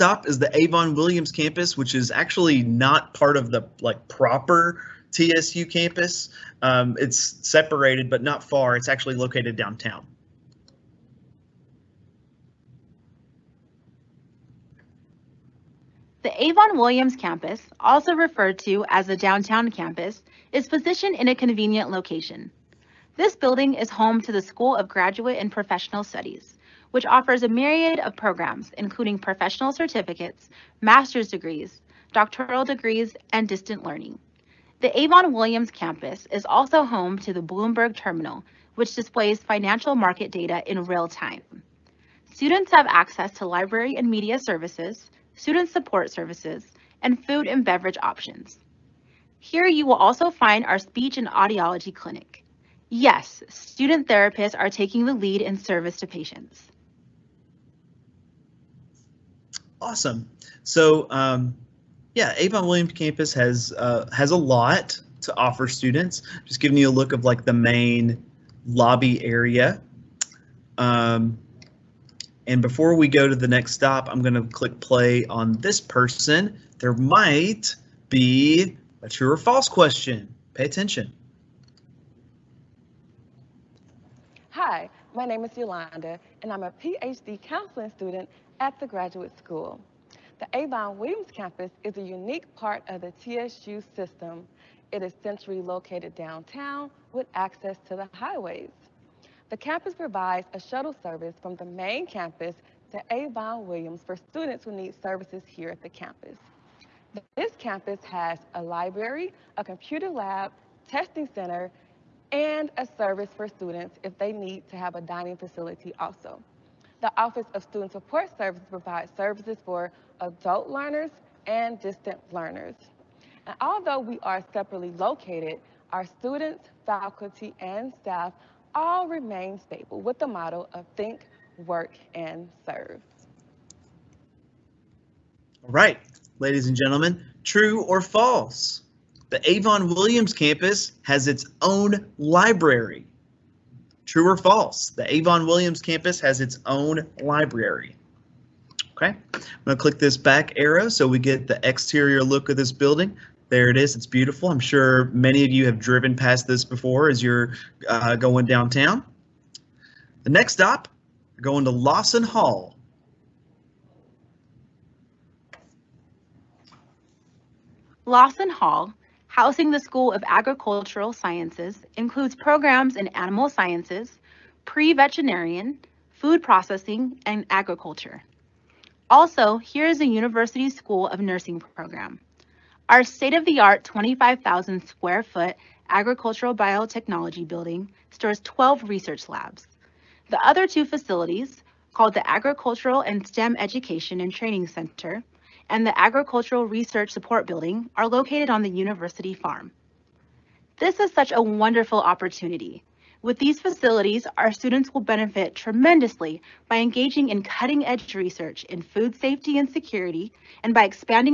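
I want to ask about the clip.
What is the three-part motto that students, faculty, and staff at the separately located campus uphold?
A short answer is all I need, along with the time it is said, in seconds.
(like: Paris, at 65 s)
Think, work, and serve, at 130 s.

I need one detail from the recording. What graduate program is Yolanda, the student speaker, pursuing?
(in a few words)
PhD counseling.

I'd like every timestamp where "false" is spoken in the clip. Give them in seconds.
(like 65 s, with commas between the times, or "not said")
79 s, 138 s, 144 s.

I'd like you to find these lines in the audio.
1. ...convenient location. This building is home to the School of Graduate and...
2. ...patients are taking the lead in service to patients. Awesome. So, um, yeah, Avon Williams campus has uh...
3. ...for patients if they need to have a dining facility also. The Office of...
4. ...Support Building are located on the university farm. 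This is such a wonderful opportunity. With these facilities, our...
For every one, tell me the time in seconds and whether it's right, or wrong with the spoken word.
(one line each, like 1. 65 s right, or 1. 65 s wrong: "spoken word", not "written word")
1. 21 s right
2. 54 s wrong: "therapists", not "patients"
3. 113 s wrong: "students", not "patients"
4. 197 s right.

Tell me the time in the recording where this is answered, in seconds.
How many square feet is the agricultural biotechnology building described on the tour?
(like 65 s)
183 s.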